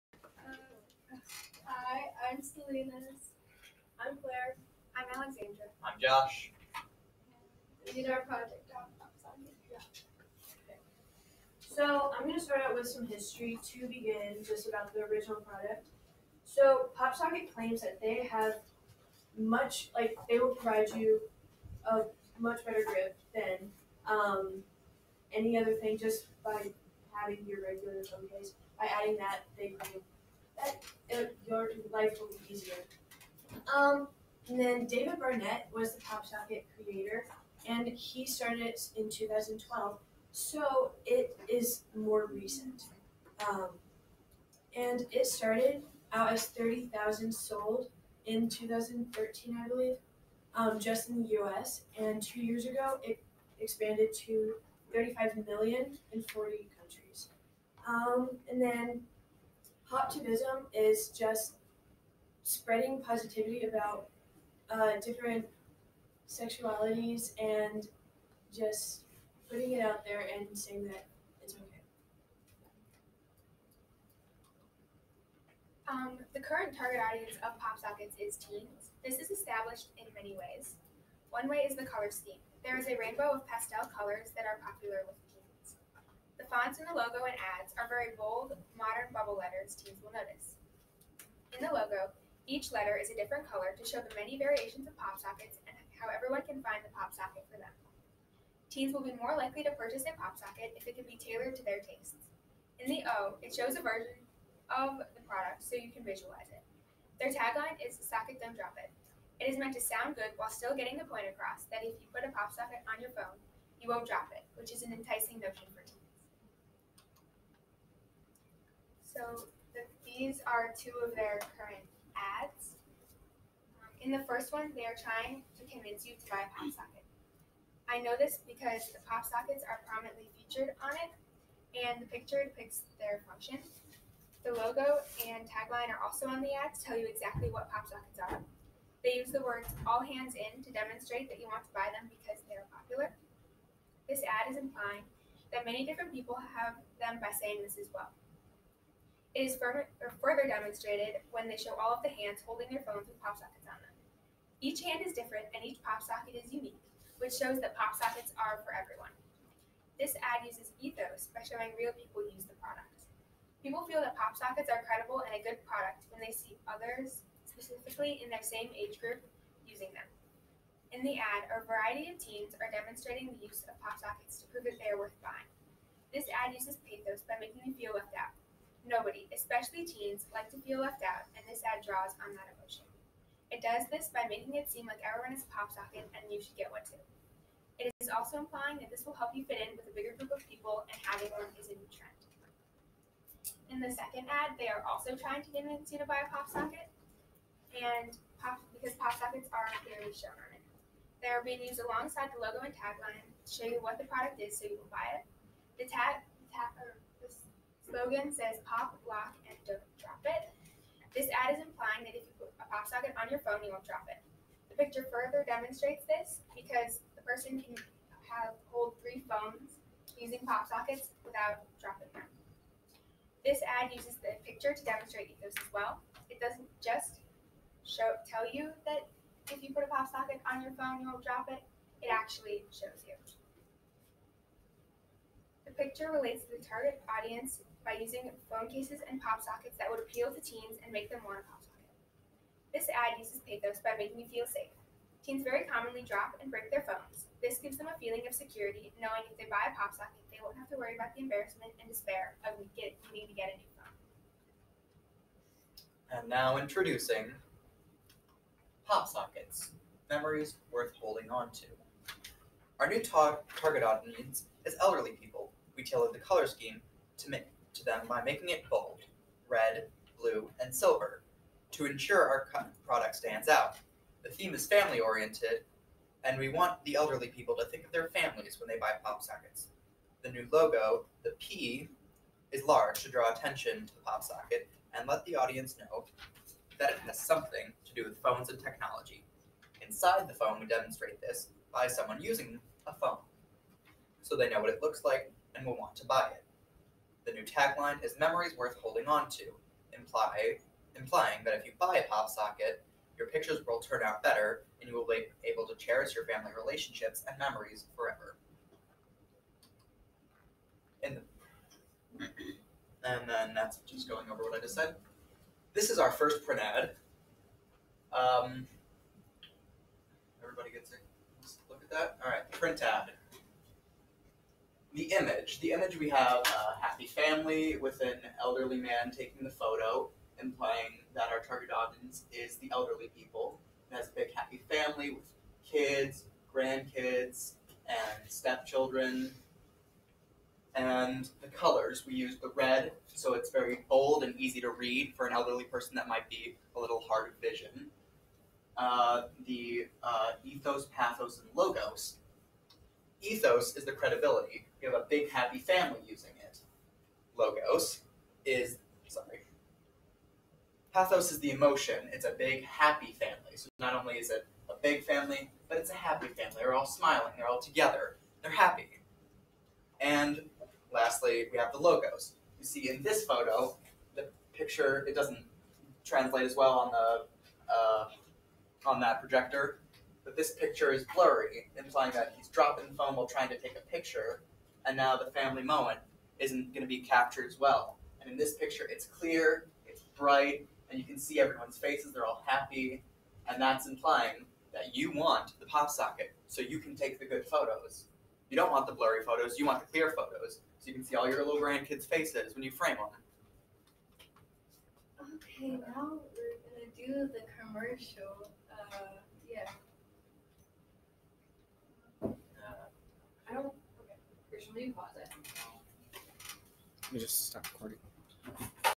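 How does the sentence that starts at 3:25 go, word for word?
The tag, the tag er, slogan says pop, lock, and don't drop it.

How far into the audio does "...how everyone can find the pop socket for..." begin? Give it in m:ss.
1:35.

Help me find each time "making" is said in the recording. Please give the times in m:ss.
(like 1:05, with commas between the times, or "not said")
2:57, 3:04, 4:03, 4:28.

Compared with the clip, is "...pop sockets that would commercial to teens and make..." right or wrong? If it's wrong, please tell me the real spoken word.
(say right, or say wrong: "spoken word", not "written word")
wrong: "appeal", not "commercial".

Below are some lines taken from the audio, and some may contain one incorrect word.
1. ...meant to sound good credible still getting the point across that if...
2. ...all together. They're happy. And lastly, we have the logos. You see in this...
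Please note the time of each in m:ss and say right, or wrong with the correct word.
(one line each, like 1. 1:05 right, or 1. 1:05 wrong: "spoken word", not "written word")
1. 1:49 wrong: "while", not "credible"
2. 6:07 right.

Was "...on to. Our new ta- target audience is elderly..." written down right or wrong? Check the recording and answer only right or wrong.
right.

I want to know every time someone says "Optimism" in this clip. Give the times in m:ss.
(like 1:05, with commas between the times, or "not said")
0:59.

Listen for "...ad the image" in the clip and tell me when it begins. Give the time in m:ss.
5:22.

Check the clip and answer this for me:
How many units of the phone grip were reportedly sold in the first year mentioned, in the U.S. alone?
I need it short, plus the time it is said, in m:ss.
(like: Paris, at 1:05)
30,000, at 0:46.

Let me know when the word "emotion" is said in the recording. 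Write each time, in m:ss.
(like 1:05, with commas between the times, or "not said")
3:02, 6:01.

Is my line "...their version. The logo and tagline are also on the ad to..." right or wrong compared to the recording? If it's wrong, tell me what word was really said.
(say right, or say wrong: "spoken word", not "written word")
wrong: "function", not "version".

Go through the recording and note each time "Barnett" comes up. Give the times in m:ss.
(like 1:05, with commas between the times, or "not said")
0:35.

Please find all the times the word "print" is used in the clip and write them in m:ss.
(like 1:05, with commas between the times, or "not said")
5:16, 5:22.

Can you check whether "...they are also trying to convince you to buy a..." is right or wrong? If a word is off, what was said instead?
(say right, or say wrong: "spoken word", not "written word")
right.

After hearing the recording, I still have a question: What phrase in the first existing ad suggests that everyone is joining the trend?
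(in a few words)
all hands in.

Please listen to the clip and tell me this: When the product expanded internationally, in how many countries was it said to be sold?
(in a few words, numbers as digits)
40.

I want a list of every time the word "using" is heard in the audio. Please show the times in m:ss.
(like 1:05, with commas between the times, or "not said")
2:49, 3:40, 3:57, 4:52, 5:56.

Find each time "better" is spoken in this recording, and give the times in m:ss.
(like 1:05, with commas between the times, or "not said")
0:22, 5:04.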